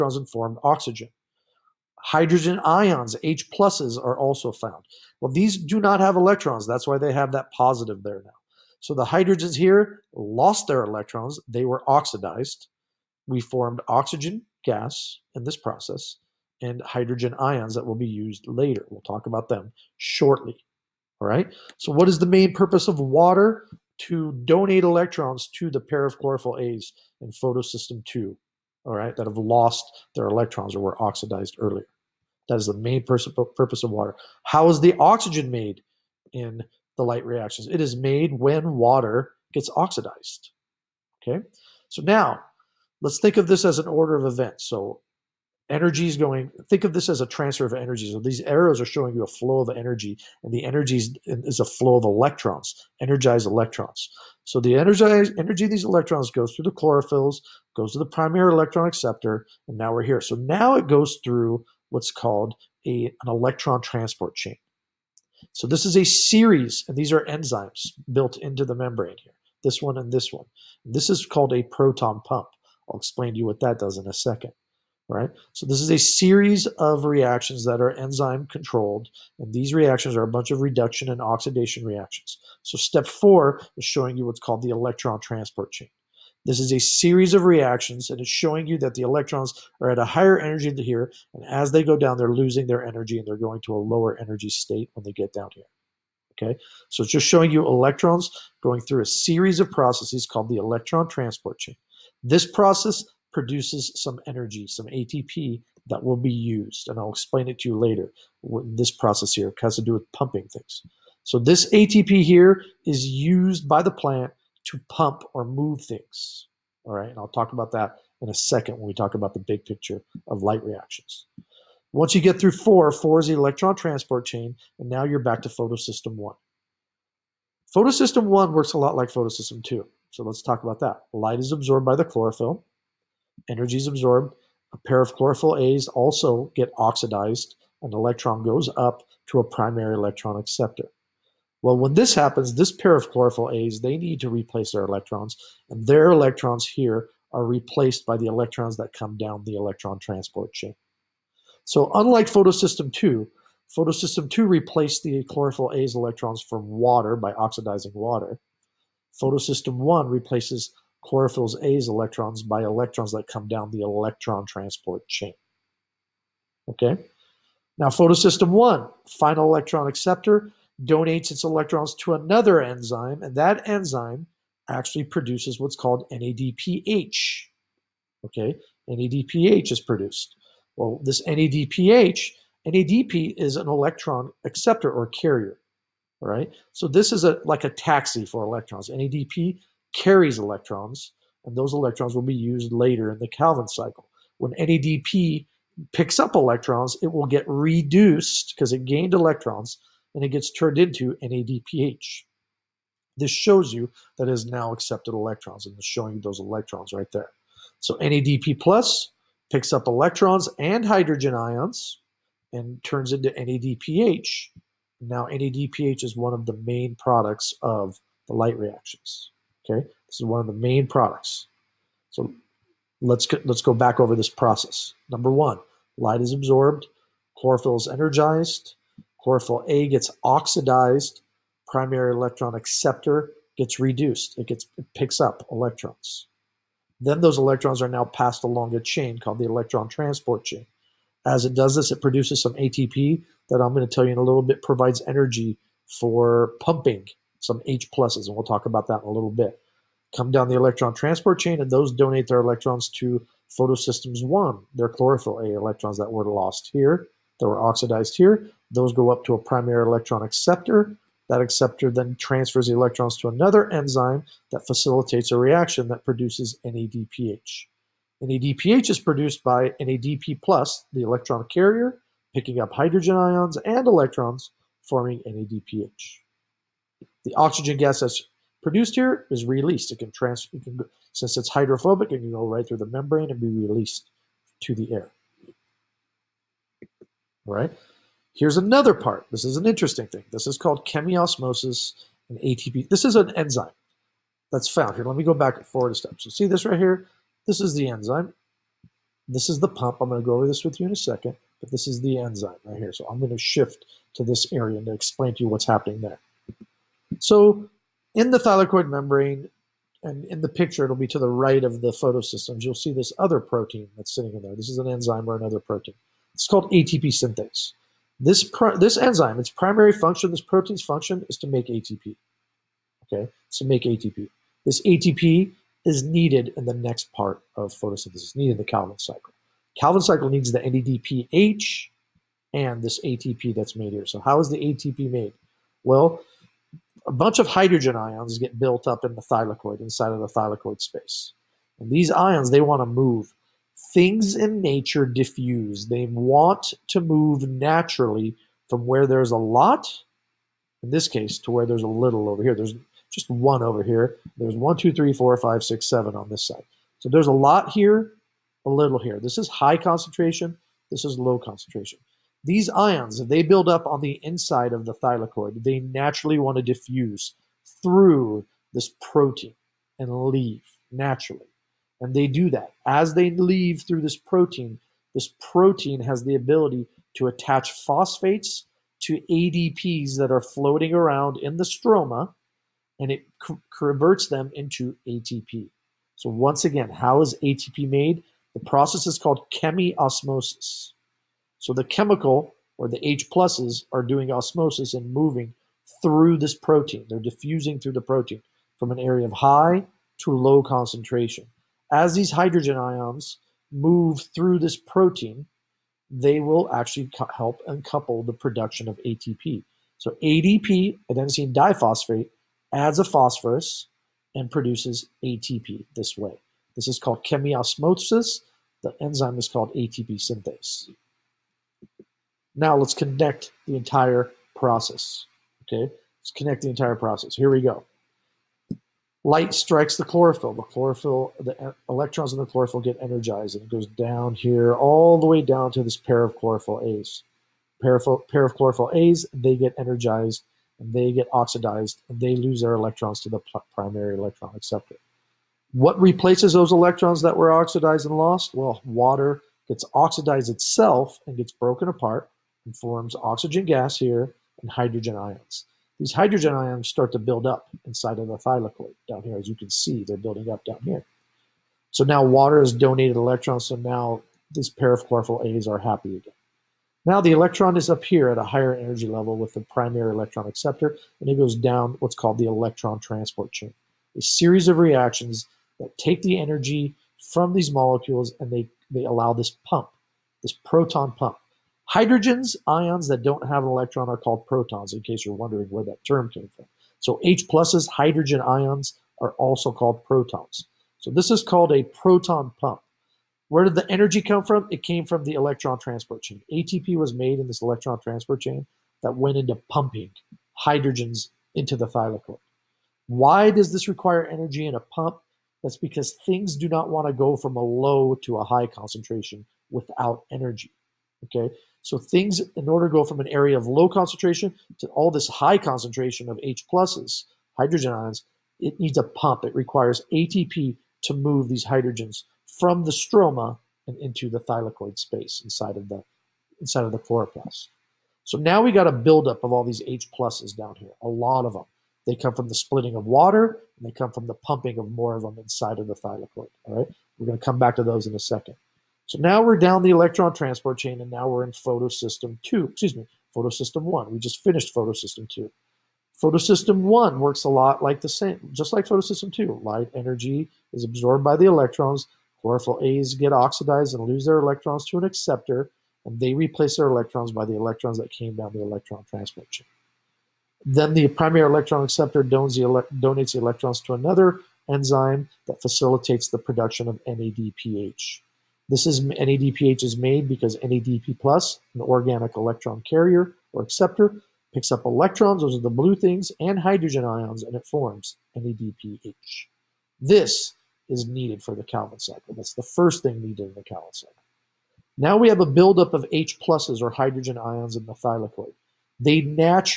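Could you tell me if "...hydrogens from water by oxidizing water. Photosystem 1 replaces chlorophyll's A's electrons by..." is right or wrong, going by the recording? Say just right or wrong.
wrong.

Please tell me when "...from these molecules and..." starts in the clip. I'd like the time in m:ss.
7:57.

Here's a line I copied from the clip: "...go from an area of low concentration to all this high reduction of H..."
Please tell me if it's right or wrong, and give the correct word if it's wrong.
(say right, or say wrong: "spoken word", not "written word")
wrong: "concentration", not "reduction".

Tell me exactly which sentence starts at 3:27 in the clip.
So NADP plus picks up electrons and hydrogen ions and turns into NADPH.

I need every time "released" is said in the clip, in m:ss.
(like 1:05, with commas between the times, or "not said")
4:39, 4:43.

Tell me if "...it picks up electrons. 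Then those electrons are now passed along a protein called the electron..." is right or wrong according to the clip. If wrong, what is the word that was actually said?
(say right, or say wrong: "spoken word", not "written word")
wrong: "chain", not "protein".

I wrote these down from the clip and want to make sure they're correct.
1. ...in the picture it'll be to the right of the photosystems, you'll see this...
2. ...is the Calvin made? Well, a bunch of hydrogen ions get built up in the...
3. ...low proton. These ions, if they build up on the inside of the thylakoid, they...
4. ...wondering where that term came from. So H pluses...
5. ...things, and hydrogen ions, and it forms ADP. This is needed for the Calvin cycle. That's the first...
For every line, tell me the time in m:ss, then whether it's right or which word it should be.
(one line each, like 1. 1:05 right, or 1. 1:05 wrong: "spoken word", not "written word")
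1. 5:10 right
2. 5:34 wrong: "ATP", not "Calvin"
3. 6:01 wrong: "concentration", not "proton"
4. 8:05 right
5. 9:35 wrong: "NADPH", not "ADP".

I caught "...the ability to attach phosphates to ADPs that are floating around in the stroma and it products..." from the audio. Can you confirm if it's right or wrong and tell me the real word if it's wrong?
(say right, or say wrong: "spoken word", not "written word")
wrong: "converts", not "products".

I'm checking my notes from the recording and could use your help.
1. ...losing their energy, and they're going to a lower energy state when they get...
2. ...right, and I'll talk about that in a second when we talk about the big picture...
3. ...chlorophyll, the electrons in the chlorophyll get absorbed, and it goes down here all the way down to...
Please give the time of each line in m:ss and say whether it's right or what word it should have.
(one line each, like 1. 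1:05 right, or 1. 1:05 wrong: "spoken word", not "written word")
1. 1:32 right
2. 1:56 right
3. 7:10 wrong: "energized", not "absorbed".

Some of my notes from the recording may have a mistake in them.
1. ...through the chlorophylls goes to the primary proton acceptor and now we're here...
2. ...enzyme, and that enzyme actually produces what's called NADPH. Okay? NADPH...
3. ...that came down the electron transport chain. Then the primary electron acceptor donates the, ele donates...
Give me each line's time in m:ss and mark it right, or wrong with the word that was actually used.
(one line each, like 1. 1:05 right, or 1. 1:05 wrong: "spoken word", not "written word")
1. 0:56 wrong: "electron", not "proton"
2. 2:52 right
3. 9:17 right.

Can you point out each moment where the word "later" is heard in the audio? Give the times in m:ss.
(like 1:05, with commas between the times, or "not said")
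0:18, 1:47, 3:12.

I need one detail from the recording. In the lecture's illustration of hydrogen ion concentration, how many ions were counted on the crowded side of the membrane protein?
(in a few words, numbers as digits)
7.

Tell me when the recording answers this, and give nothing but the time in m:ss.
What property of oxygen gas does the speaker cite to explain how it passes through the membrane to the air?
4:41.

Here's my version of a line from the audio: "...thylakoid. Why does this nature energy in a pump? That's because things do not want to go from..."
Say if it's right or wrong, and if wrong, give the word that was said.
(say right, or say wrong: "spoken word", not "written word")
wrong: "require", not "nature".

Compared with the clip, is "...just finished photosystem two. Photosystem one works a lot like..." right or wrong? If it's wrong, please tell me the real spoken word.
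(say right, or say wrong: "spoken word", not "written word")
right.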